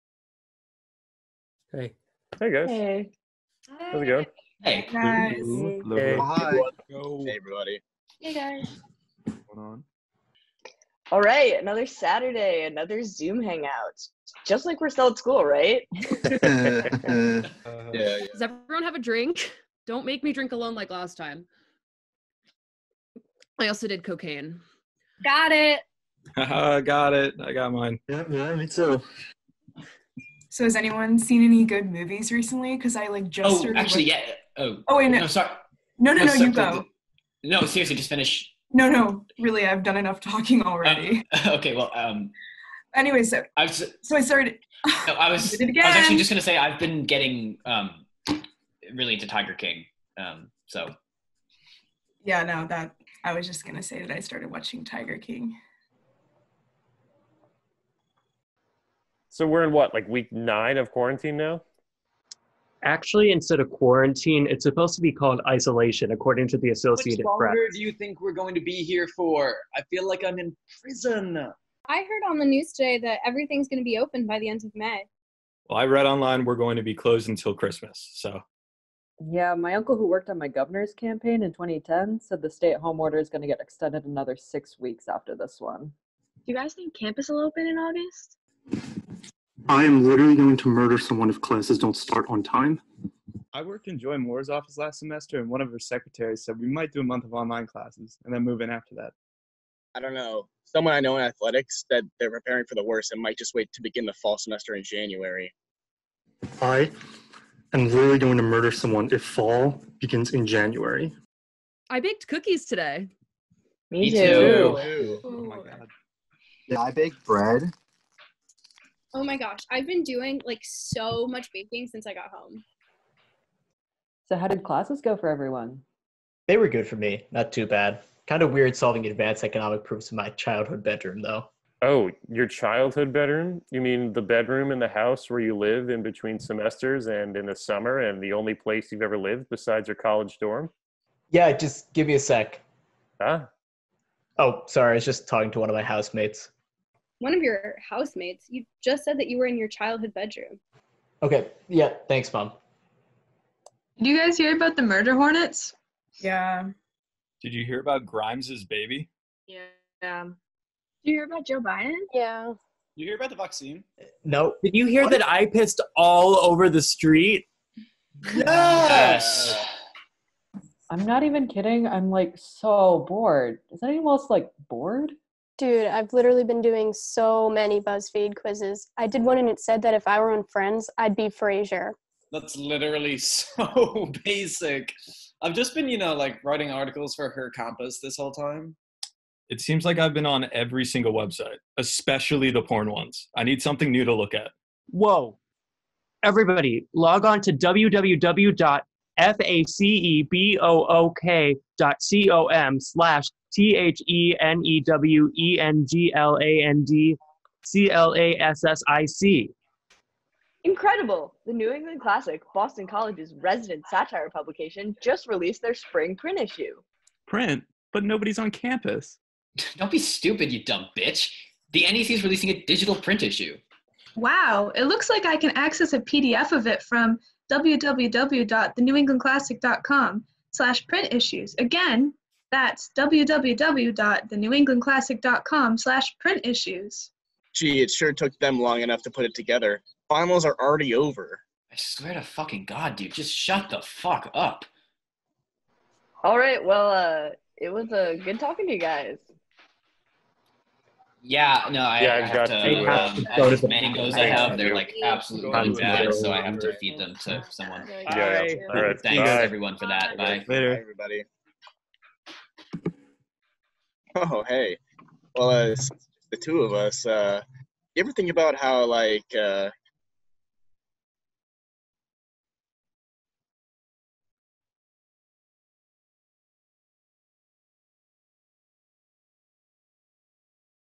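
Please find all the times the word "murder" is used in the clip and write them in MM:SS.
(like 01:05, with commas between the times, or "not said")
01:30, 01:48, 02:34.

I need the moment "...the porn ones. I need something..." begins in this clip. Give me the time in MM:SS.
03:12.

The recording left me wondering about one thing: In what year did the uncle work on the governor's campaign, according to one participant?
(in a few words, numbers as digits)
2010.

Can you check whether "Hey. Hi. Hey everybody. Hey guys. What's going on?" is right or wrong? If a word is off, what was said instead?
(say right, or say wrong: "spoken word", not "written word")
right.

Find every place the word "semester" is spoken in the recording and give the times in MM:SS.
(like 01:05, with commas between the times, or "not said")
01:34, 01:44, 02:16.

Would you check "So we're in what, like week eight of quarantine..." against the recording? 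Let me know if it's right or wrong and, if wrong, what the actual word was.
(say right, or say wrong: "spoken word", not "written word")
wrong: "nine", not "eight".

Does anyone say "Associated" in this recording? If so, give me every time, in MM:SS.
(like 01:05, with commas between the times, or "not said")
01:06.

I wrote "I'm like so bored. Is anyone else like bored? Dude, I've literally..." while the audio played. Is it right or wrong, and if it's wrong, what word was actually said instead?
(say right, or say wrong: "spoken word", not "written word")
right.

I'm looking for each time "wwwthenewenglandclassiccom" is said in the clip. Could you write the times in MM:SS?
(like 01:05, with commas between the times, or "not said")
03:47, 03:52.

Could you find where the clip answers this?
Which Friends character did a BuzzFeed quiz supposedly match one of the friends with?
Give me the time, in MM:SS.
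03:01.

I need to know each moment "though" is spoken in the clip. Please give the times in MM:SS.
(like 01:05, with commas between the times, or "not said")
02:11.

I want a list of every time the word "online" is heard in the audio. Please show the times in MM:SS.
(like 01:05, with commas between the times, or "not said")
01:16, 01:37.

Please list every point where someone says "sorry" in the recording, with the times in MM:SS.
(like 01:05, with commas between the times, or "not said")
00:35, 02:24.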